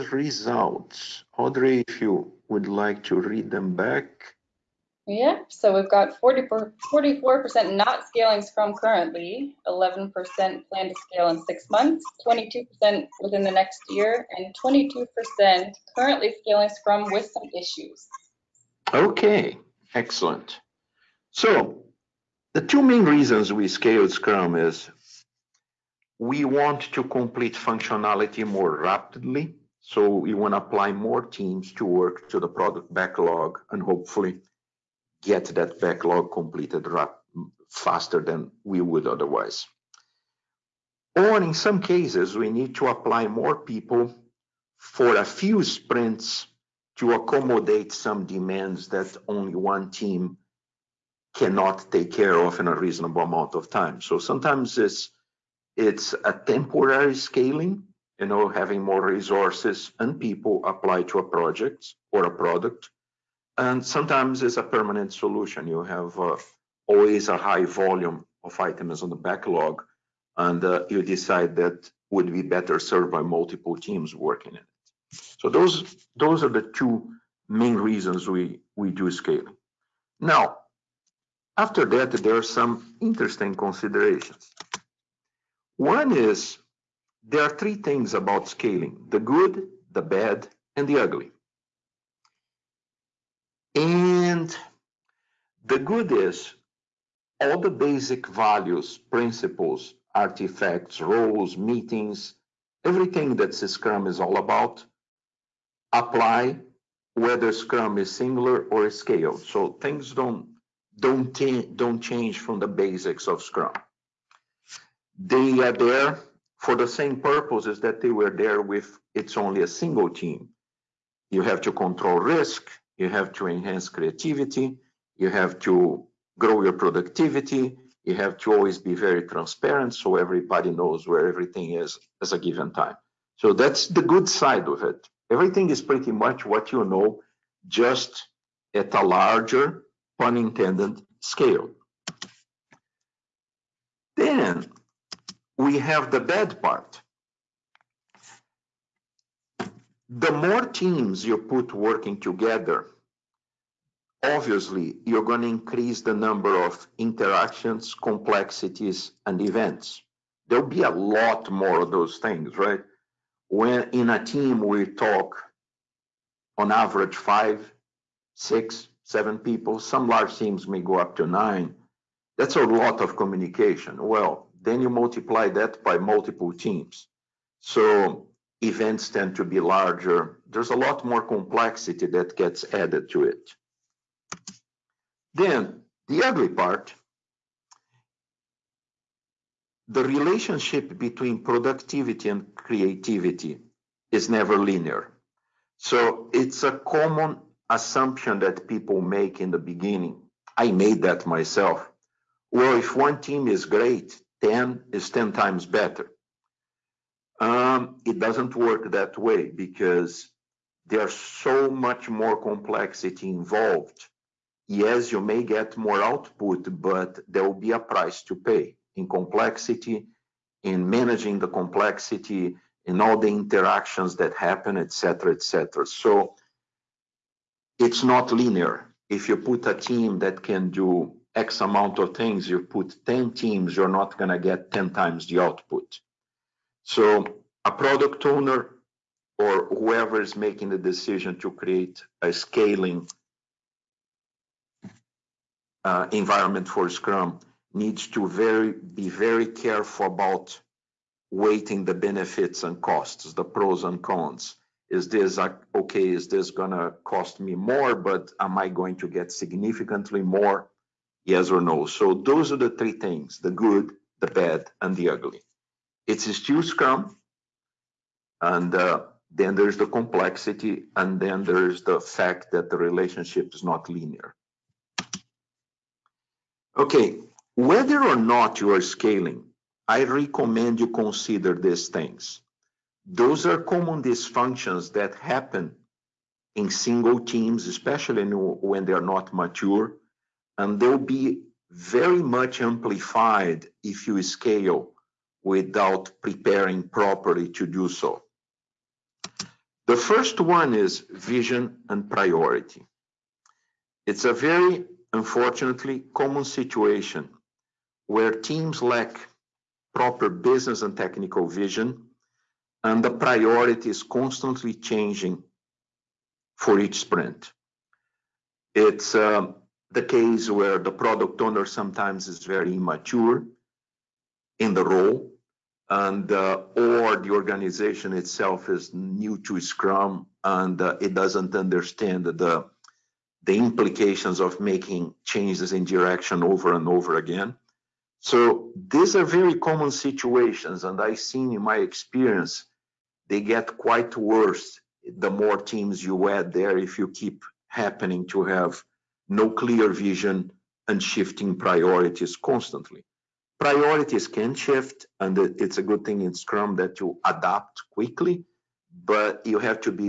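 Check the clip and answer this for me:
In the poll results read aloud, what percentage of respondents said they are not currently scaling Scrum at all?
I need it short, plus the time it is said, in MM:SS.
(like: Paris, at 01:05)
44%, at 00:06.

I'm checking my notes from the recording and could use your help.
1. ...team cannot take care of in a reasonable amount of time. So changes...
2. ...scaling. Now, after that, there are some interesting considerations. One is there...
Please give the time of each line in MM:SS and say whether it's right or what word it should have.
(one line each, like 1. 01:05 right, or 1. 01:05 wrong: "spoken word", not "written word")
1. 00:49 wrong: "sometimes", not "changes"
2. 01:19 right.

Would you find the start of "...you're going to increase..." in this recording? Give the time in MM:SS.
02:35.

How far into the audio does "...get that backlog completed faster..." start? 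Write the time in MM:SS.
00:35.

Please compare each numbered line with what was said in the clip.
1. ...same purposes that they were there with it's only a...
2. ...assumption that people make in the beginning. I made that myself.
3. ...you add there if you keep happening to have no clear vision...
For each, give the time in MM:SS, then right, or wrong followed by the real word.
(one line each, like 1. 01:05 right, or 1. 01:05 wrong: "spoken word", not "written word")
1. 01:56 right
2. 03:17 right
3. 05:46 right.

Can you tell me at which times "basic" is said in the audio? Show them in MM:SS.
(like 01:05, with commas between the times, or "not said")
01:37, 01:52.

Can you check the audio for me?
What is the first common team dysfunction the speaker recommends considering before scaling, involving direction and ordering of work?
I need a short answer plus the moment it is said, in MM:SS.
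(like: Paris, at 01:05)
vision and priority, at 05:01.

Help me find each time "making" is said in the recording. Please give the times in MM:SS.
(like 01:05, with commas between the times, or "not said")
04:00, 05:34.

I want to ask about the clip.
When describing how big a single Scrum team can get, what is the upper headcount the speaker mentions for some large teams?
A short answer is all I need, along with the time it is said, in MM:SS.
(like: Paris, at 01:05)
9, at 02:51.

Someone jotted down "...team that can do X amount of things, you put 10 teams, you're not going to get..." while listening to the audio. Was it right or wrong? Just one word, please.
right.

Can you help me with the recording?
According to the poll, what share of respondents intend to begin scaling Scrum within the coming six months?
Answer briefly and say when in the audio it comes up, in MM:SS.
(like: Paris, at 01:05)
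11%, at 00:09.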